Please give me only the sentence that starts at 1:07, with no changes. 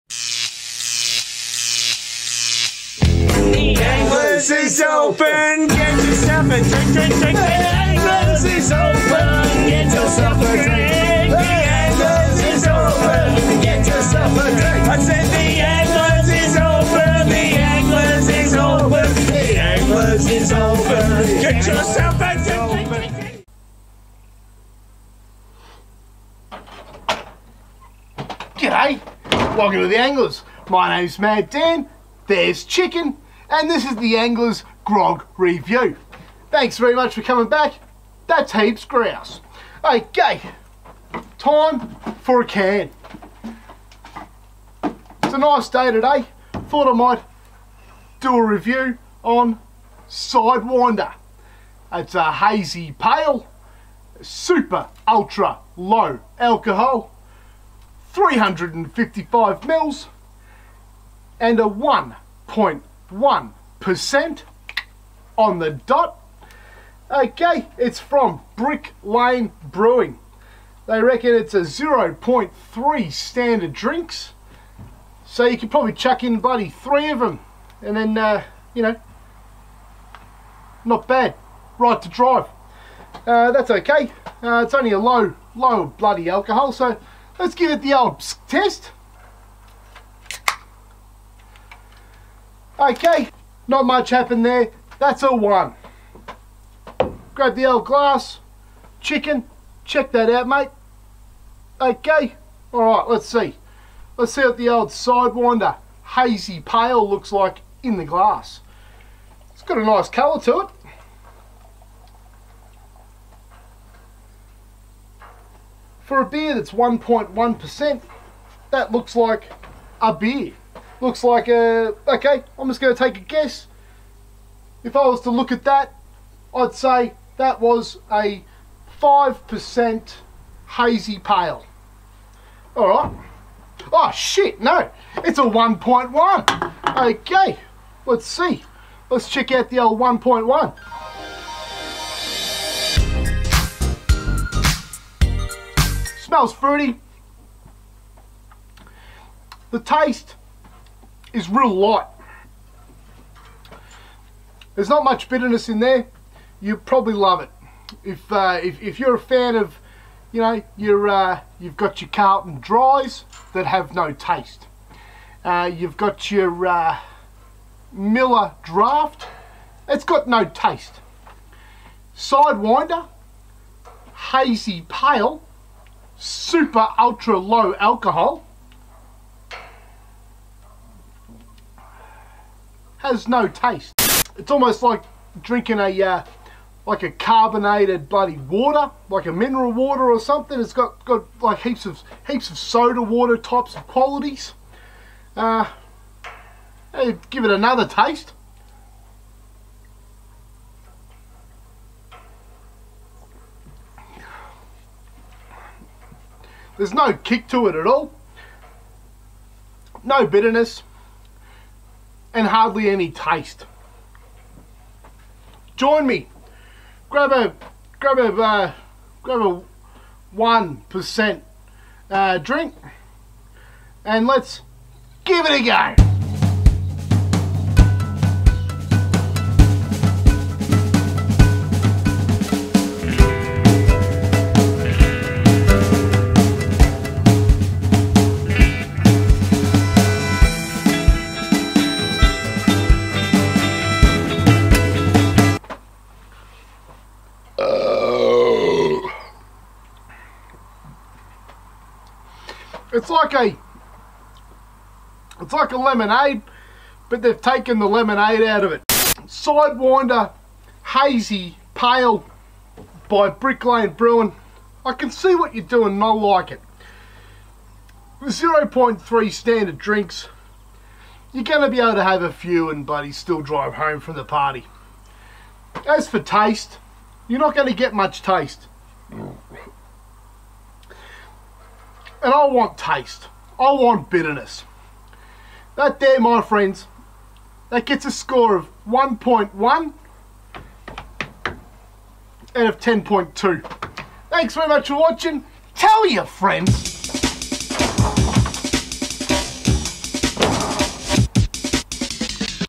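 Okay, it's from Brick Lane Brewing.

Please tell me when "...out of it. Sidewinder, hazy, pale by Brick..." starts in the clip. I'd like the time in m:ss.
4:18.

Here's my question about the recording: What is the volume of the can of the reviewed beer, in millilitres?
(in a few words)
355.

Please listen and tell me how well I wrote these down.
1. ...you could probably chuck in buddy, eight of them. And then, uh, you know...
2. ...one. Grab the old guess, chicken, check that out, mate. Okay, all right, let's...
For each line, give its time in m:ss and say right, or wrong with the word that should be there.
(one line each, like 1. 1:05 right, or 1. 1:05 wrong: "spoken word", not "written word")
1. 1:15 wrong: "three", not "eight"
2. 1:35 wrong: "glass", not "guess".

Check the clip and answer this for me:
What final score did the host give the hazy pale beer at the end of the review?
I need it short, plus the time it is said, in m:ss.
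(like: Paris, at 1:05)
1.1 out of 10.2, at 4:48.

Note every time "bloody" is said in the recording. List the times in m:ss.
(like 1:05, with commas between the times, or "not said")
1:25, 3:08.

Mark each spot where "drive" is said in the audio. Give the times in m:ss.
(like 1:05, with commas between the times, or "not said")
1:22, 4:33.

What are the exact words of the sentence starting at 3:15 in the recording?
Uh, eh, give it another taste.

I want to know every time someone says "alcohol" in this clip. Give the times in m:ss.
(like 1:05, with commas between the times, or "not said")
0:56, 1:26, 2:57.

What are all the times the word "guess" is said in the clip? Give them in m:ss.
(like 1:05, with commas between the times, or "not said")
2:03.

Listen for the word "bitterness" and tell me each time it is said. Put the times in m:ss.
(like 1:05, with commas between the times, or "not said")
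2:35, 3:30, 4:44.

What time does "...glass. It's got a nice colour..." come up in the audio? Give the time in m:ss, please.
1:48.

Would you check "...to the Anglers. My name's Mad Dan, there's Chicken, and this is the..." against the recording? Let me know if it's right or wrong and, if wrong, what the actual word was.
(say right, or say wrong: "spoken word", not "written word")
right.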